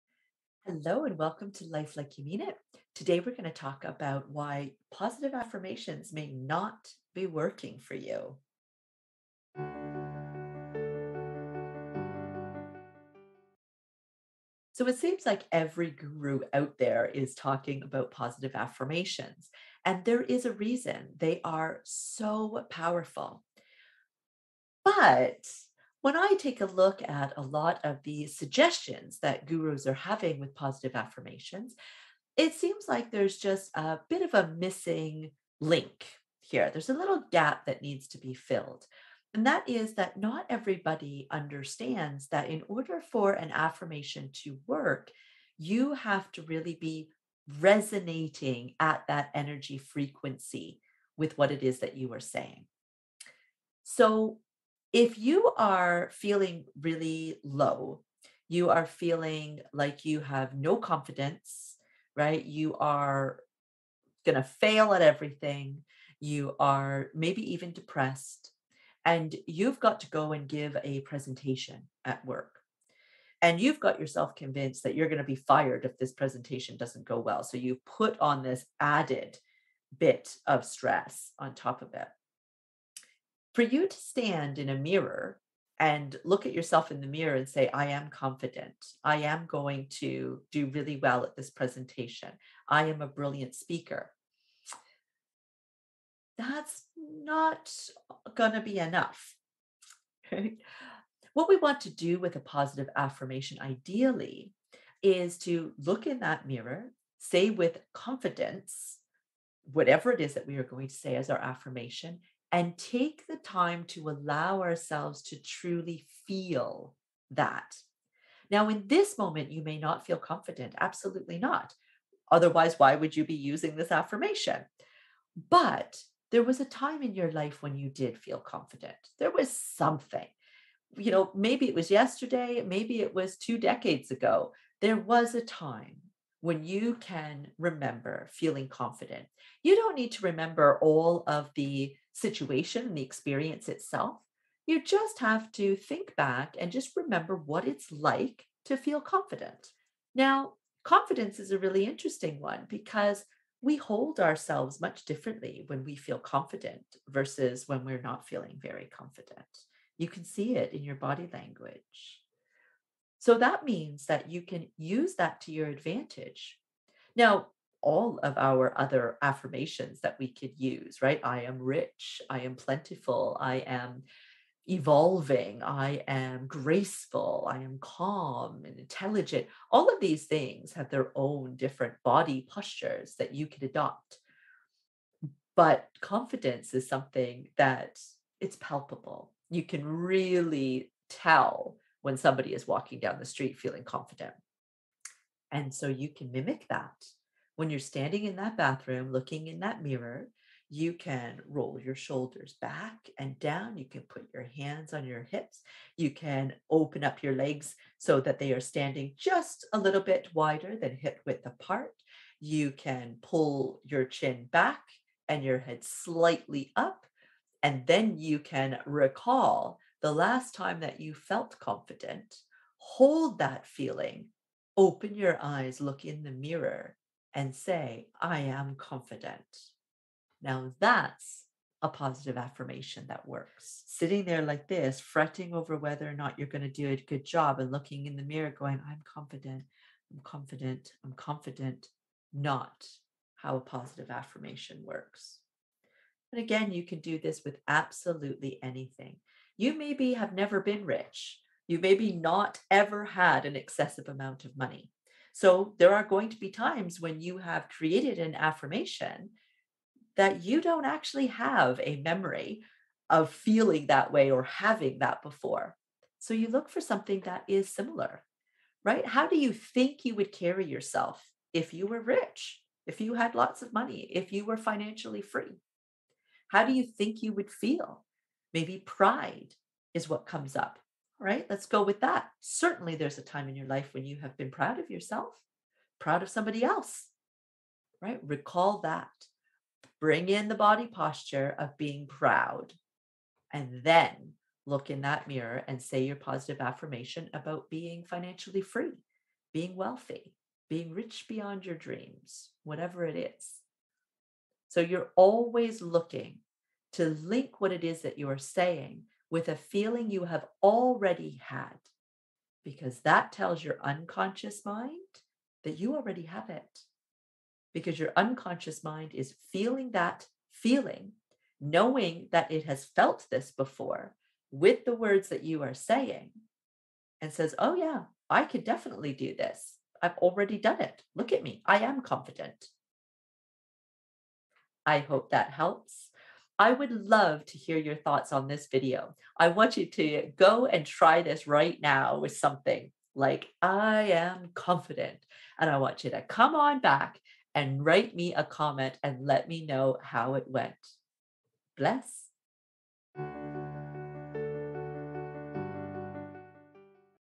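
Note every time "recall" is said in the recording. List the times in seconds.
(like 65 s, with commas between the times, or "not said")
218 s, 288 s.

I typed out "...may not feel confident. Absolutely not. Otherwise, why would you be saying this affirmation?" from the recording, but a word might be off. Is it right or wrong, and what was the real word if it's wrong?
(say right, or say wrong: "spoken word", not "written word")
wrong: "using", not "saying".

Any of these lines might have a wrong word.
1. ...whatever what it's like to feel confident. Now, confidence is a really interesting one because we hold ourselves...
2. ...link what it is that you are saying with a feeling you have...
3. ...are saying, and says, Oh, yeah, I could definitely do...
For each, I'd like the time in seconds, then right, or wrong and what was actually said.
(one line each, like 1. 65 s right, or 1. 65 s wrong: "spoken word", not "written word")
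1. 146 s wrong: "remember", not "whatever"
2. 307 s right
3. 325 s right.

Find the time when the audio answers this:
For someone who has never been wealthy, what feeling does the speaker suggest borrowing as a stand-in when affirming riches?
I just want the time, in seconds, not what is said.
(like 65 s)
278 s.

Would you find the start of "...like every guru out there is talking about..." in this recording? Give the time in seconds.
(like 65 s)
15 s.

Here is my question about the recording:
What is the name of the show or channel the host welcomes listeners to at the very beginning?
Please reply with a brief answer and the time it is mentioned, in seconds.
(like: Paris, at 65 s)
Life Like You Mean It, at 1 s.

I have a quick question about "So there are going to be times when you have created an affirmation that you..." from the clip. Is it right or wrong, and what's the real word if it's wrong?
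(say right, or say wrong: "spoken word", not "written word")
right.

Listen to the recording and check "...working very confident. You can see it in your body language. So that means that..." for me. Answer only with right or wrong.
wrong.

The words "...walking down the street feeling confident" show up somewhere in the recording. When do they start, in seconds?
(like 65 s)
192 s.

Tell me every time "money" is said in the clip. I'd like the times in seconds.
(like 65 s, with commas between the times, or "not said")
254 s, 273 s.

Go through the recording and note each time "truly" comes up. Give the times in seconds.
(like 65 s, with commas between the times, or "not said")
115 s.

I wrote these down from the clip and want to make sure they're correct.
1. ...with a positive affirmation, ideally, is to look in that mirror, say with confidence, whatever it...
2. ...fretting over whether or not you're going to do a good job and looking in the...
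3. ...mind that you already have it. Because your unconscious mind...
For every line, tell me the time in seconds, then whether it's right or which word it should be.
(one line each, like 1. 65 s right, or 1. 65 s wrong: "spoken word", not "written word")
1. 102 s right
2. 234 s right
3. 314 s right.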